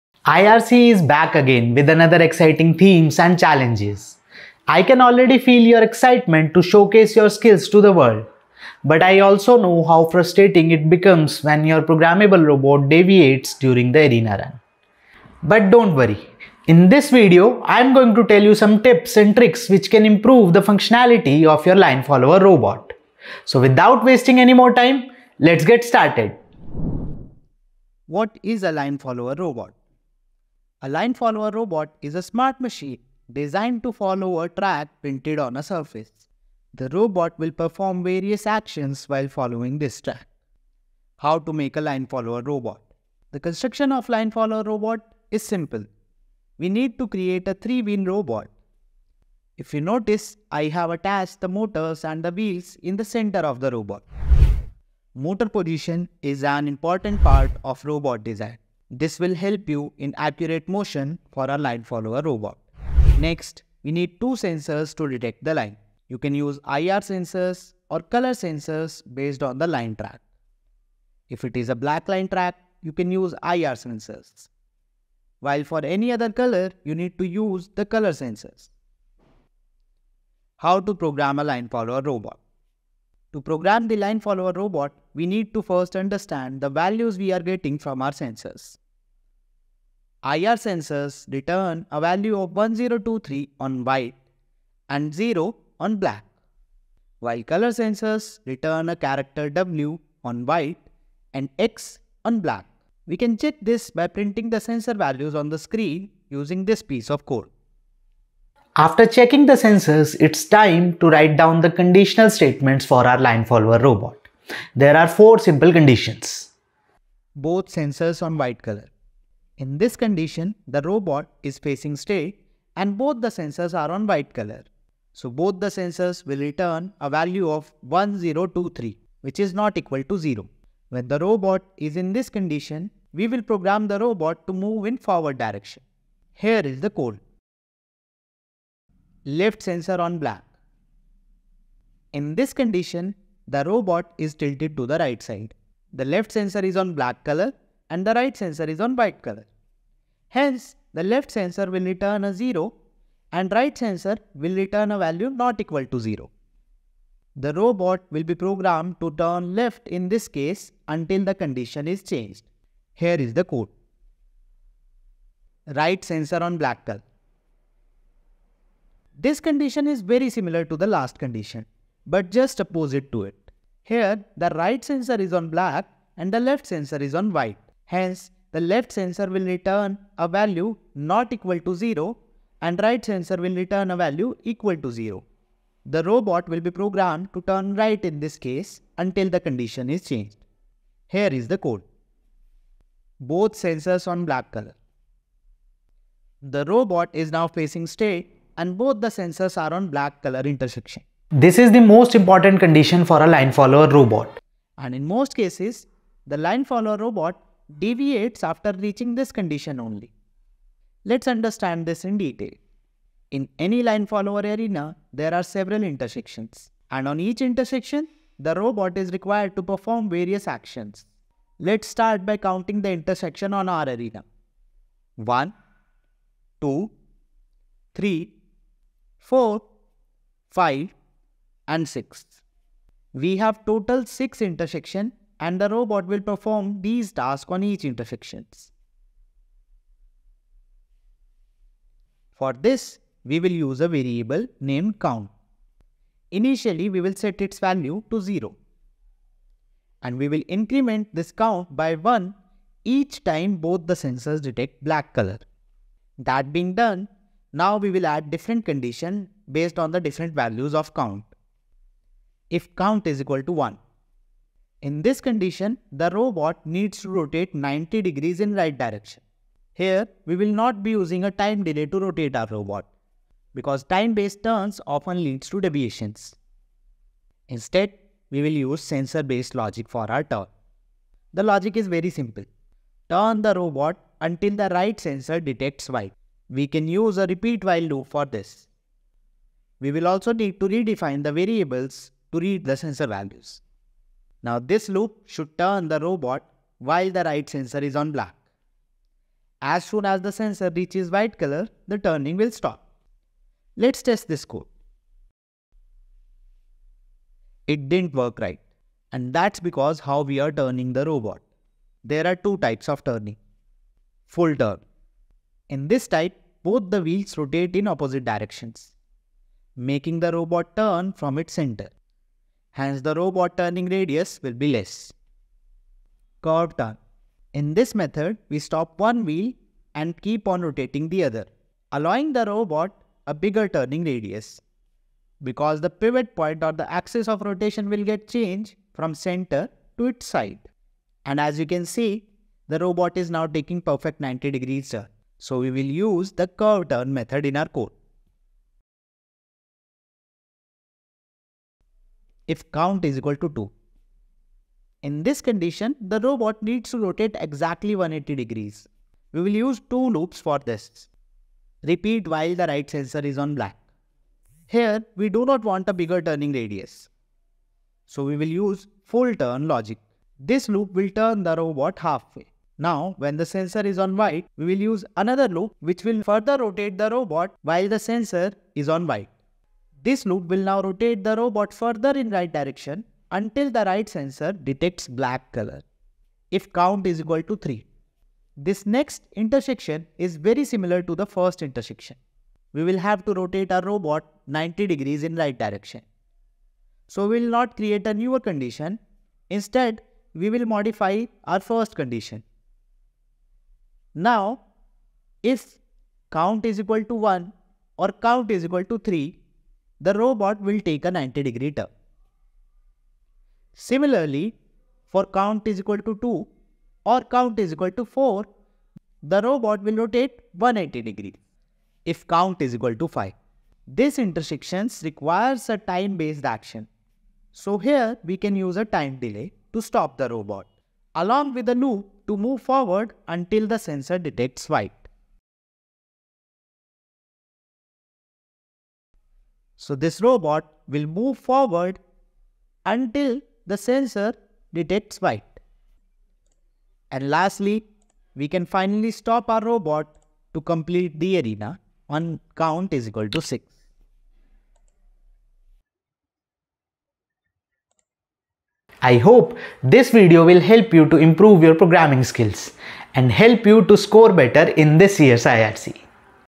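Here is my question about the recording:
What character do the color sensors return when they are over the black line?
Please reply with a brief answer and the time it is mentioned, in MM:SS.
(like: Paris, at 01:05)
X, at 01:41.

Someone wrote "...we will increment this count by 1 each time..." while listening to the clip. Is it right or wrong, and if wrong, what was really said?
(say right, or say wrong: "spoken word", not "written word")
right.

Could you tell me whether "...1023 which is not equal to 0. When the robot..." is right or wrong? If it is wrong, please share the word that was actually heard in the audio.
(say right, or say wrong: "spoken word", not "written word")
right.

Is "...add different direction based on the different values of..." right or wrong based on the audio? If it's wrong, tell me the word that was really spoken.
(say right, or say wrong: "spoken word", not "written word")
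wrong: "condition", not "direction".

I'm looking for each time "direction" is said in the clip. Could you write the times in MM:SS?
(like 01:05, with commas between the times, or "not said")
02:15, 04:28, 05:18, 06:22, 06:35.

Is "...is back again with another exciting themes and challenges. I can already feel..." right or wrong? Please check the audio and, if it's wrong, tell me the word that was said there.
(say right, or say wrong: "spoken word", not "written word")
right.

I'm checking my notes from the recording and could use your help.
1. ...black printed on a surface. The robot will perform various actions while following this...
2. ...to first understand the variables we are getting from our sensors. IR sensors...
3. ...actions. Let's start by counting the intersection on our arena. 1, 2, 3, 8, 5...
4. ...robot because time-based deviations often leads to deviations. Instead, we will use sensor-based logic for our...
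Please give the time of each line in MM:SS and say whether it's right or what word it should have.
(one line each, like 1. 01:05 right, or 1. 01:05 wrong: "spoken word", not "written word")
1. 00:34 wrong: "track", not "black"
2. 01:25 wrong: "values", not "variables"
3. 03:40 wrong: "4", not "8"
4. 04:32 wrong: "turns", not "deviations".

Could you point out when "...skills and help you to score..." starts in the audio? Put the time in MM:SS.
07:42.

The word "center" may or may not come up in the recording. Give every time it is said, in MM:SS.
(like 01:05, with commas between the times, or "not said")
00:53, 05:21, 05:39.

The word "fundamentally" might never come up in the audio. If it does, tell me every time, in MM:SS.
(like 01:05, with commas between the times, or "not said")
not said.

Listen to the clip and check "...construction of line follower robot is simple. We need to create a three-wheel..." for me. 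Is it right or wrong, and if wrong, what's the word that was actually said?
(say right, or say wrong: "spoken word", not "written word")
right.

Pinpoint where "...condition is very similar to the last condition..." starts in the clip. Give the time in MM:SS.
02:49.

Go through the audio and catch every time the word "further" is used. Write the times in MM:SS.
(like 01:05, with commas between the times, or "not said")
06:16, 06:21.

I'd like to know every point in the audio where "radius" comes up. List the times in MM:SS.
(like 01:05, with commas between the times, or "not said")
05:23, 05:34, 06:06.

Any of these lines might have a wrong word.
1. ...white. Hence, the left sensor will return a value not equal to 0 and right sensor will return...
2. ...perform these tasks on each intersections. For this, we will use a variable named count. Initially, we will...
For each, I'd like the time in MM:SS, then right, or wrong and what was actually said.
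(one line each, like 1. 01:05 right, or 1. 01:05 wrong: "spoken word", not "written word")
1. 02:57 right
2. 03:56 right.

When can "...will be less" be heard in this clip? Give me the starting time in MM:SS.
05:24.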